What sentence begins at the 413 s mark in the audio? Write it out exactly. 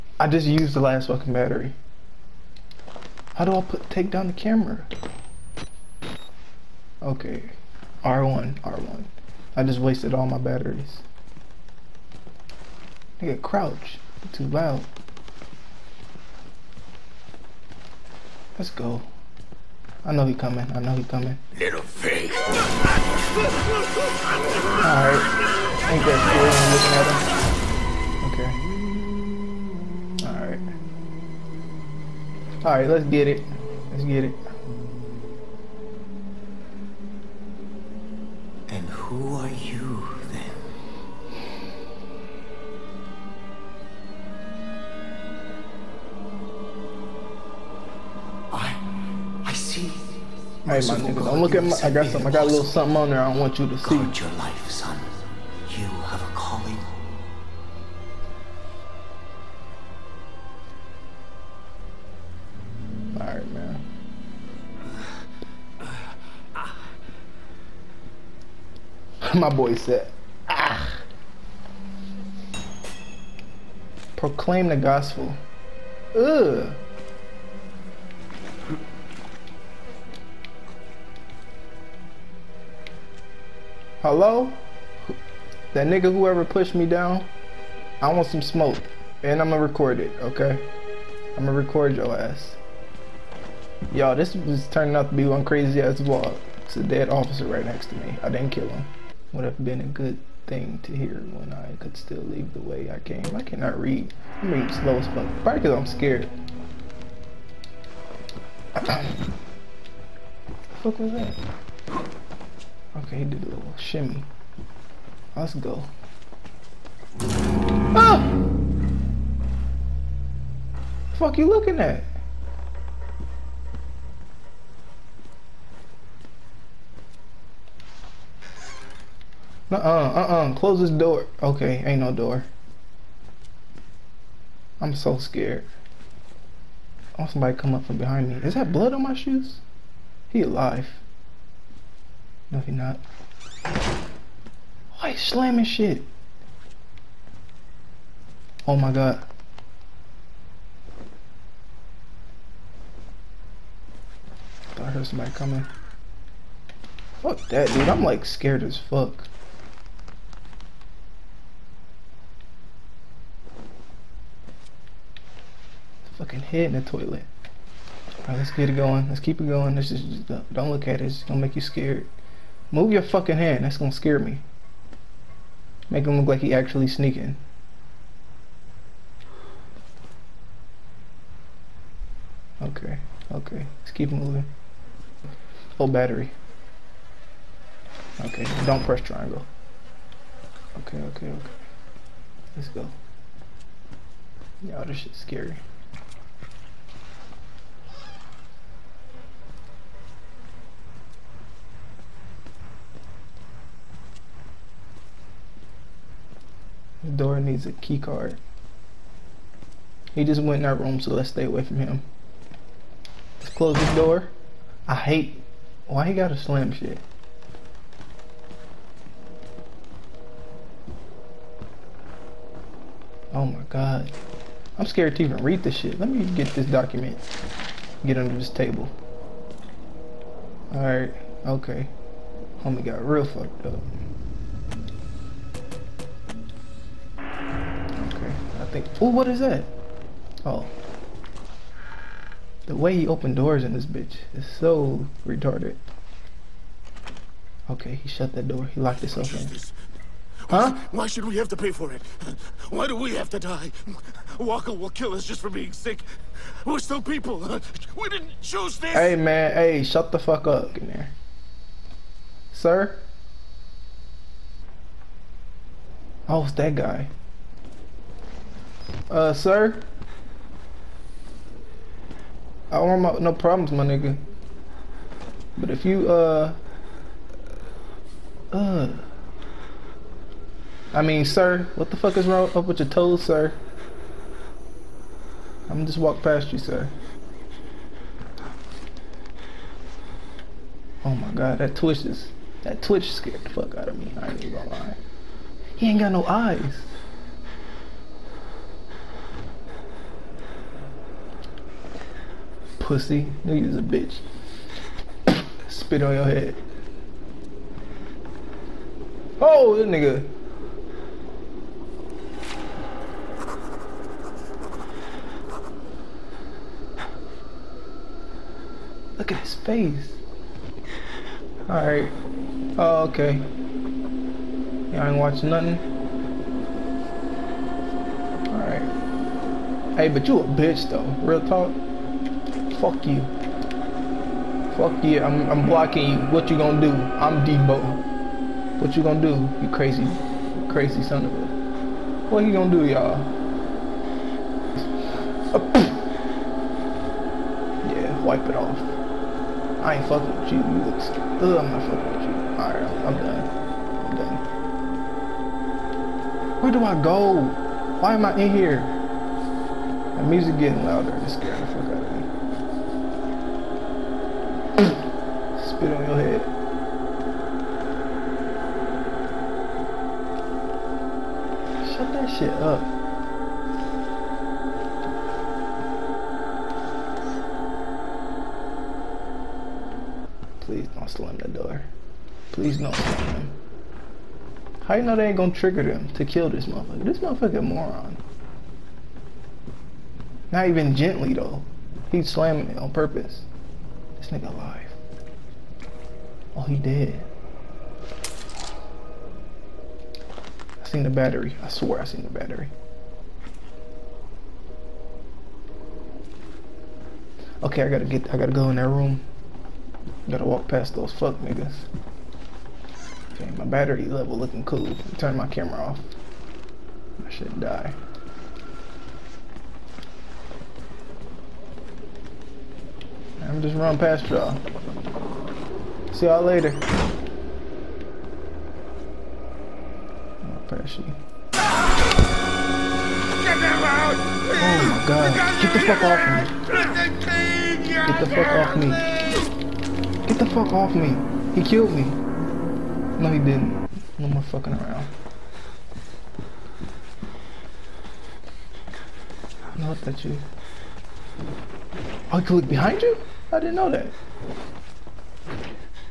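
Okay, my battery level looking cool.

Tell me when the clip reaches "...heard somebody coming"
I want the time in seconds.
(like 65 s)
154 s.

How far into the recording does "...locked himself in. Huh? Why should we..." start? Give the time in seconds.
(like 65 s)
248 s.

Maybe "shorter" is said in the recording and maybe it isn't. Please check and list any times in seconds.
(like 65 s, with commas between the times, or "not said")
not said.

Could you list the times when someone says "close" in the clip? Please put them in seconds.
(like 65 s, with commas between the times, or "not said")
130 s, 213 s.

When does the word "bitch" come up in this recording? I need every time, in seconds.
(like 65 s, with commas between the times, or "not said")
243 s, 303 s, 330 s.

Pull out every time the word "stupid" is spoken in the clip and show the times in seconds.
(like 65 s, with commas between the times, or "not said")
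351 s.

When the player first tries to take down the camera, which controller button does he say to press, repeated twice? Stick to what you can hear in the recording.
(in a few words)
R1.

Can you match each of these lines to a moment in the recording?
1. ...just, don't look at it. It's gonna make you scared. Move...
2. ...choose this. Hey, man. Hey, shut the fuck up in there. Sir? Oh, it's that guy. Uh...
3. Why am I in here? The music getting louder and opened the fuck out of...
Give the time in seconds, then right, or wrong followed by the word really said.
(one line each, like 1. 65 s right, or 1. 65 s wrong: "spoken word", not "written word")
1. 169 s right
2. 258 s right
3. 358 s wrong: "scared", not "opened".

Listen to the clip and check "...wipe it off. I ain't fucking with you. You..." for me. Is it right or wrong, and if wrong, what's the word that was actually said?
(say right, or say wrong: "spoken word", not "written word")
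right.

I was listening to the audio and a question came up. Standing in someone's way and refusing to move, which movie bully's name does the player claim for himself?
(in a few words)
Debo.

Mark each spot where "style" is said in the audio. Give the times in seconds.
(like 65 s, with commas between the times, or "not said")
not said.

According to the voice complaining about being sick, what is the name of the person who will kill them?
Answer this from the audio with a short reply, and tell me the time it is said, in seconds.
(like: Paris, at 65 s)
Walker, at 254 s.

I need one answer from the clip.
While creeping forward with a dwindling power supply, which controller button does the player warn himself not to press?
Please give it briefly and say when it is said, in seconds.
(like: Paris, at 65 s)
triangle, at 188 s.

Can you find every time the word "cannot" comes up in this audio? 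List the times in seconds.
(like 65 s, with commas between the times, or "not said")
103 s.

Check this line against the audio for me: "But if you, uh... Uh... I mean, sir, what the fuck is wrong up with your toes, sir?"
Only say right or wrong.
right.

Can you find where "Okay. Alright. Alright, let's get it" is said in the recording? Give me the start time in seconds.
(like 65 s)
30 s.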